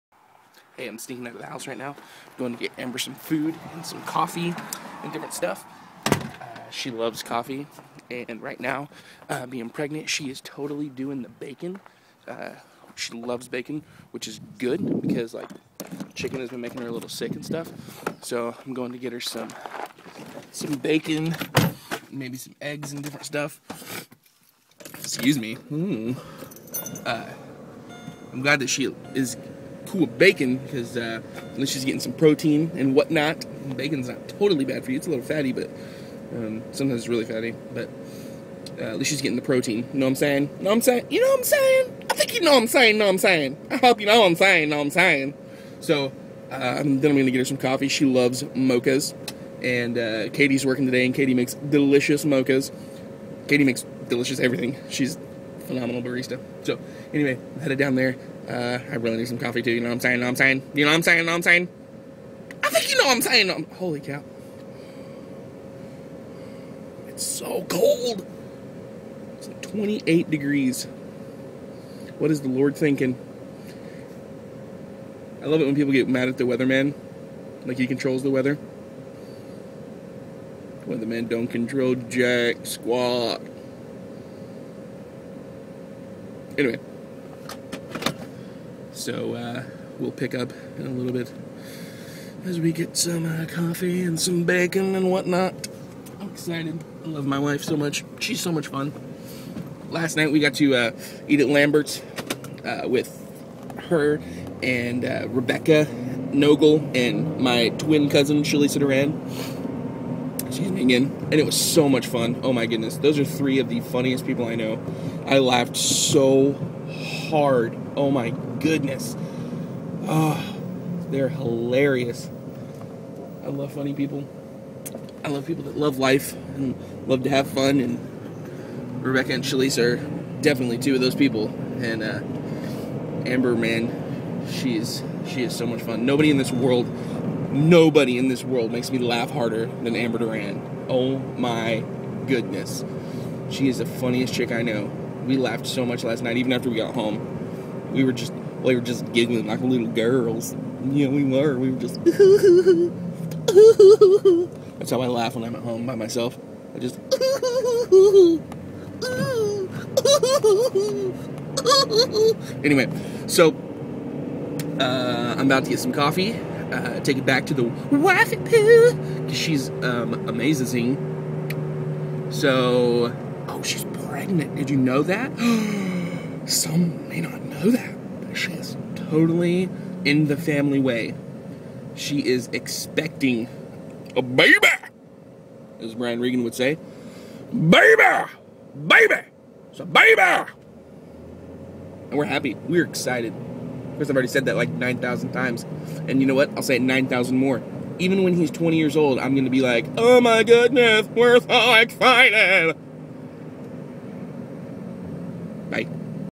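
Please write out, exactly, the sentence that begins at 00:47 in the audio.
She loves mochas, and uh, Katie's working today, and Katie makes delicious mochas.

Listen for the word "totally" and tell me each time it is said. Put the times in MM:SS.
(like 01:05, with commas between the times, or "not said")
00:10, 00:34, 02:58.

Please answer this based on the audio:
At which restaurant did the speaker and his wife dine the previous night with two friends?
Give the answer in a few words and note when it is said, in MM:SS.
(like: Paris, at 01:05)
Lambert's, at 01:41.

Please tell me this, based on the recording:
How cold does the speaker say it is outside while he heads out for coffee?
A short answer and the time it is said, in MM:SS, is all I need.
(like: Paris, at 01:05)
28 degrees, at 01:09.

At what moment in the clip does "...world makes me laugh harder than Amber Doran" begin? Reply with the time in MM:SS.
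02:18.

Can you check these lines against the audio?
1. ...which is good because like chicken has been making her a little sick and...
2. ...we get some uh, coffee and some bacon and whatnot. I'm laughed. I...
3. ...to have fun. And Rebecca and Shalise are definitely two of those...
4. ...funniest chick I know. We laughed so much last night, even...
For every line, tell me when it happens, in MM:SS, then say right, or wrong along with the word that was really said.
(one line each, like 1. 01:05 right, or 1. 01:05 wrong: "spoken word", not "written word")
1. 00:14 right
2. 01:32 wrong: "excited", not "laughed"
3. 02:07 right
4. 02:23 right.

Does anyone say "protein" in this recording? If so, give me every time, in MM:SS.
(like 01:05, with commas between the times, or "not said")
00:32, 00:39.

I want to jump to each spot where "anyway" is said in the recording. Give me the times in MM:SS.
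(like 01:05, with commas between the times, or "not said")
00:57, 01:26, 02:42.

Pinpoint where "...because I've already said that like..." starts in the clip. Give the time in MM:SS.
03:14.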